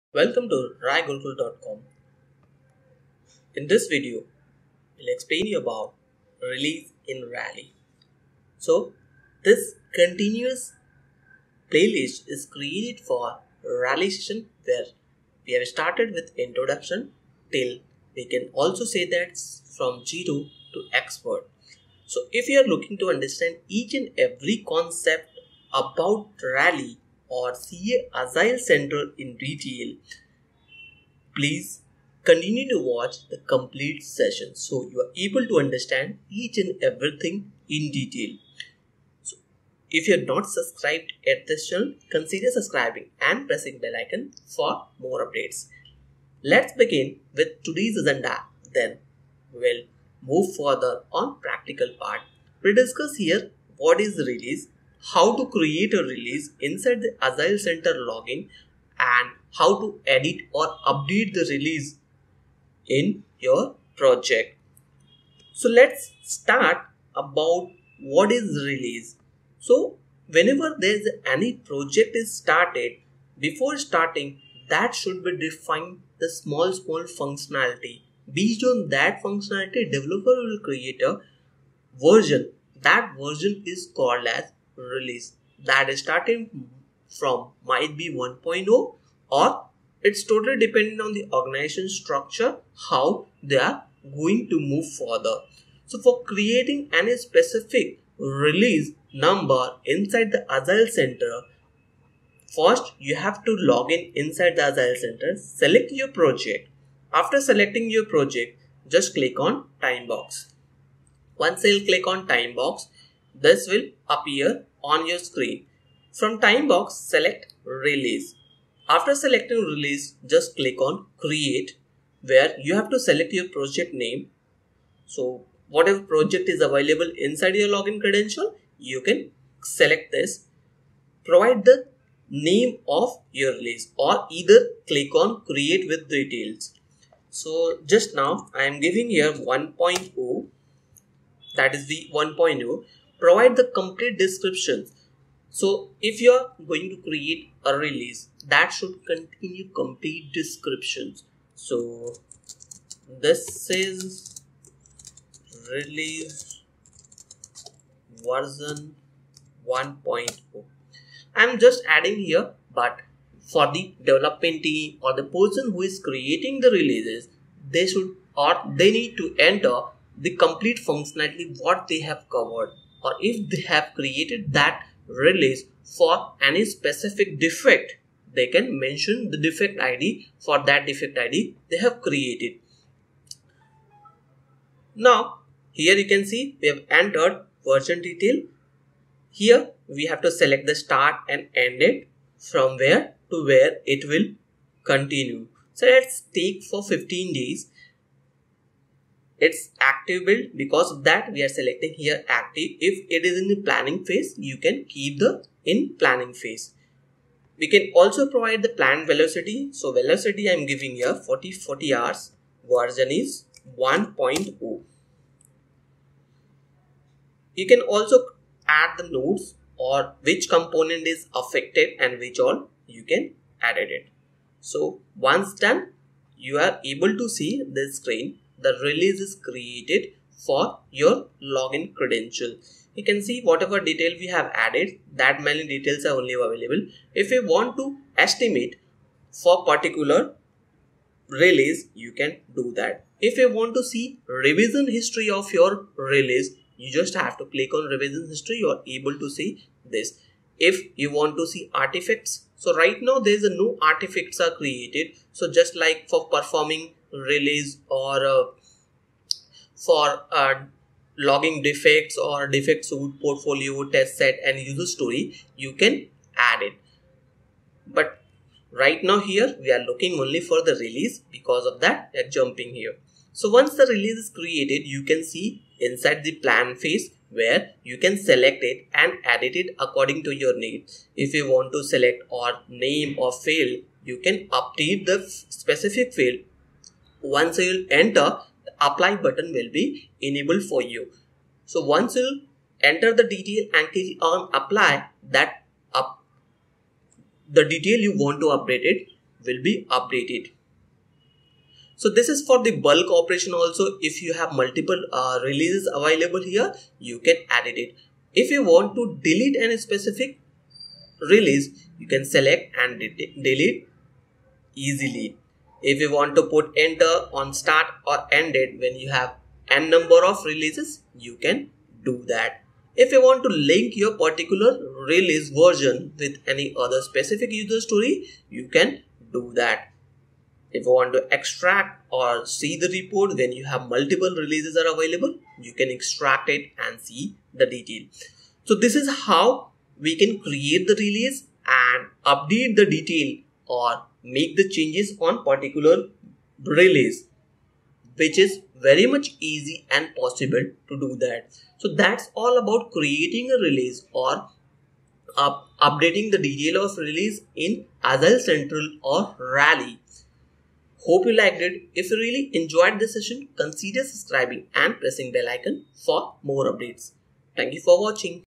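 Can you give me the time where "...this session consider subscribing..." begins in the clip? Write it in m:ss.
6:02.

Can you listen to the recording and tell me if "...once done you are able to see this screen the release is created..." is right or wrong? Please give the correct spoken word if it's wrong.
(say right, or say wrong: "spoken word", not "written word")
right.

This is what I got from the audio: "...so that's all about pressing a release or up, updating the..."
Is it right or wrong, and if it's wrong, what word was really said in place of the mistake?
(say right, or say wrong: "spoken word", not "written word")
wrong: "creating", not "pressing".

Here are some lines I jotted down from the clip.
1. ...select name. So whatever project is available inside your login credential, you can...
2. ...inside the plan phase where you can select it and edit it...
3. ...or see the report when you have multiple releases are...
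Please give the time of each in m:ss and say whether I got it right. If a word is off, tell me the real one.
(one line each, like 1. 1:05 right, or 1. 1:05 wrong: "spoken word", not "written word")
1. 2:03 wrong: "project", not "select"
2. 4:35 right
3. 5:32 right.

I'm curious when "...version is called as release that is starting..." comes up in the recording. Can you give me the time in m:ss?
1:23.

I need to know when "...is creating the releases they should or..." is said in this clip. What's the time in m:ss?
2:45.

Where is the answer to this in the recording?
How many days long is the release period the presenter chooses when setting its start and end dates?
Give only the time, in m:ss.
3:16.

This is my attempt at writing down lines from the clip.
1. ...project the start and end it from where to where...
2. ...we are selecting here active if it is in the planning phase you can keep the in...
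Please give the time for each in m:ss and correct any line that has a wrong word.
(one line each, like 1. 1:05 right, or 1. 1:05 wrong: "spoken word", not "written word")
1. 3:10 wrong: "select", not "project"
2. 3:21 right.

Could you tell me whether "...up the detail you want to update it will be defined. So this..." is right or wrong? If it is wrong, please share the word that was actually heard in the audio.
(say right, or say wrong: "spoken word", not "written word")
wrong: "updated", not "defined".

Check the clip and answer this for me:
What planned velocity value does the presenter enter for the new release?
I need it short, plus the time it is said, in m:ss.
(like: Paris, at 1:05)
40 hours, at 3:31.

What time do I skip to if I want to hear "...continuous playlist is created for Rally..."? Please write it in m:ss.
0:09.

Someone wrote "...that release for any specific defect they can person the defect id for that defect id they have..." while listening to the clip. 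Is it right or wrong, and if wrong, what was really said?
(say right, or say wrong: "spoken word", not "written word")
wrong: "mention", not "person".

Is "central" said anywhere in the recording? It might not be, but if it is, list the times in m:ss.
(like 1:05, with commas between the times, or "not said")
0:28, 0:57, 1:40, 1:44, 5:58.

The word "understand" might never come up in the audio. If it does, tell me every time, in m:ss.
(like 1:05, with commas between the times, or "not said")
0:23, 0:35.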